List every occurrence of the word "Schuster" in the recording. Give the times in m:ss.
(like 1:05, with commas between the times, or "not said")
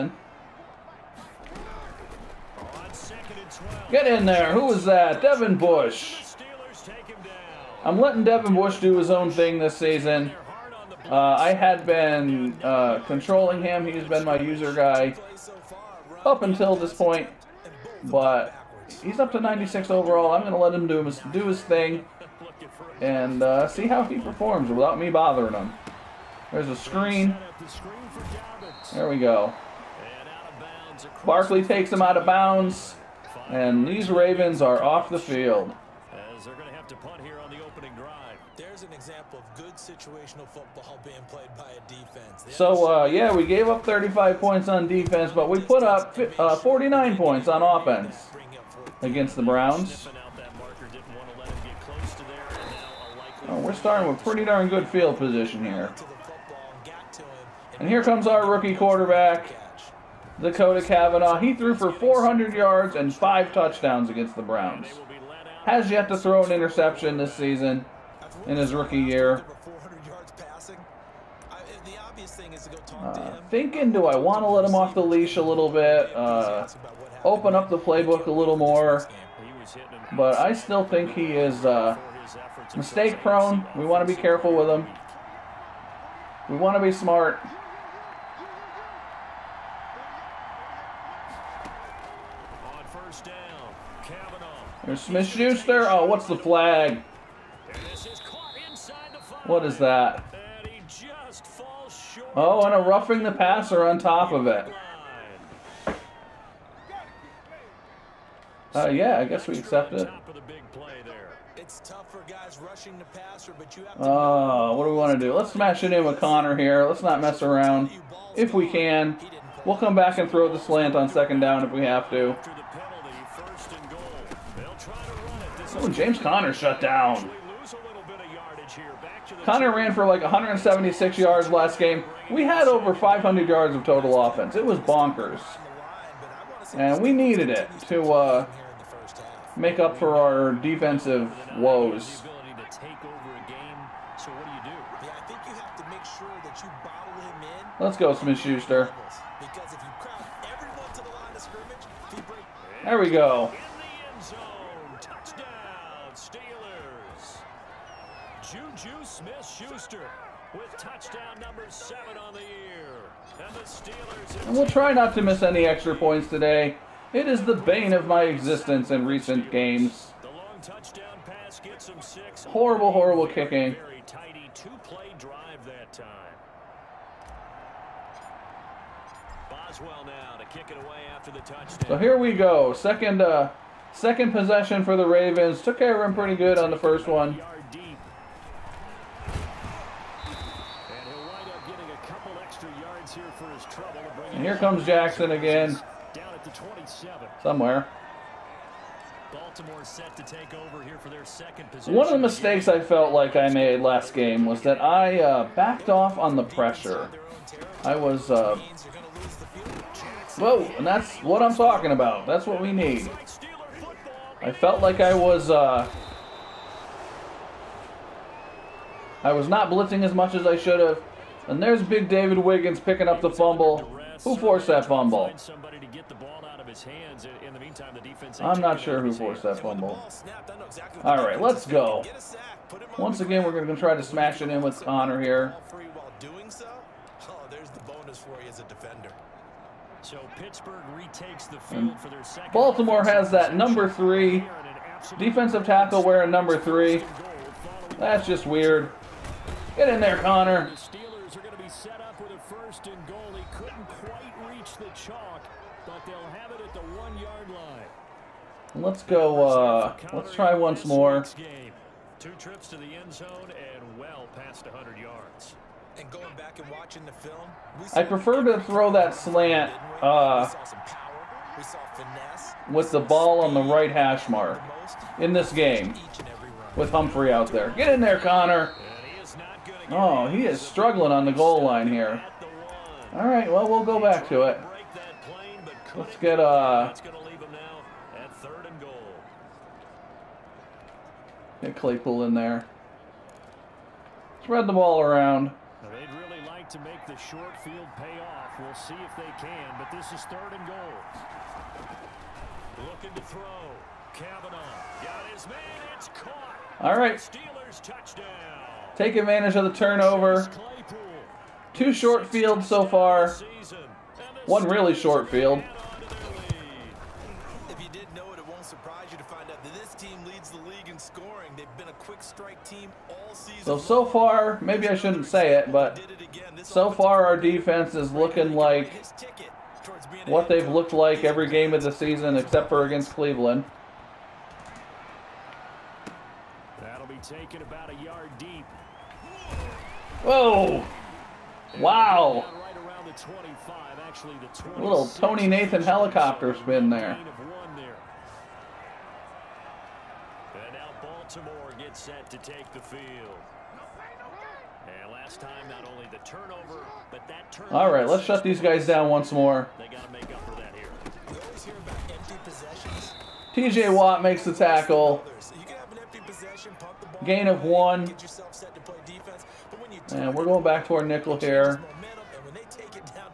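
1:35, 2:28, 2:39.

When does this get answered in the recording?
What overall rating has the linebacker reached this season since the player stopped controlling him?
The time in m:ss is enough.
0:19.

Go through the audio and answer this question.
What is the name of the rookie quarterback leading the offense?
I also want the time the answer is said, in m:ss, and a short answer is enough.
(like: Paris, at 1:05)
Dakota Cavanaugh, at 1:00.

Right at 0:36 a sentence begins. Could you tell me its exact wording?
As they're going to have to punt here on the opening drive.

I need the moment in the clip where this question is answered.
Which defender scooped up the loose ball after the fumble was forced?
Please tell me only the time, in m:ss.
3:42.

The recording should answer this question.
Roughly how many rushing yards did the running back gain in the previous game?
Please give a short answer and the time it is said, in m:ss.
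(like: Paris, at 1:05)
176, at 2:10.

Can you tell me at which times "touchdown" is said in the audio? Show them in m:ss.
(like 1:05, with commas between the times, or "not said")
1:03, 2:40, 5:07.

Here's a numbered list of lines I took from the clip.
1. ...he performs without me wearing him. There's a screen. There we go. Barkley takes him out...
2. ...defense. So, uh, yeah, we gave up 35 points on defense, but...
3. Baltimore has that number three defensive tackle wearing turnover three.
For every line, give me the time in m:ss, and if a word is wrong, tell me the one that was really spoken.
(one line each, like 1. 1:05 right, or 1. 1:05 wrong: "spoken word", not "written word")
1. 0:24 wrong: "bothering", not "wearing"
2. 0:41 right
3. 4:02 wrong: "number", not "turnover".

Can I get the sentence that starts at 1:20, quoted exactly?
But I still think he is uh, mistake prone.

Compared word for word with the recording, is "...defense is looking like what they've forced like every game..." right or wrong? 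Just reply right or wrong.
wrong.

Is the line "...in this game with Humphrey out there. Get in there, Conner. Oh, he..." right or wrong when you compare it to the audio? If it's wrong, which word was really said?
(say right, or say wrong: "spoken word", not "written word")
right.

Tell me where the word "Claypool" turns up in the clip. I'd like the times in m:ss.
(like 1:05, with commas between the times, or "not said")
4:51.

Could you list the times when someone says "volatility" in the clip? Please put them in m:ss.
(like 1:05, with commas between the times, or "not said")
not said.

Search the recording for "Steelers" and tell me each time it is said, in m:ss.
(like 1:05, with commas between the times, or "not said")
2:43, 5:07.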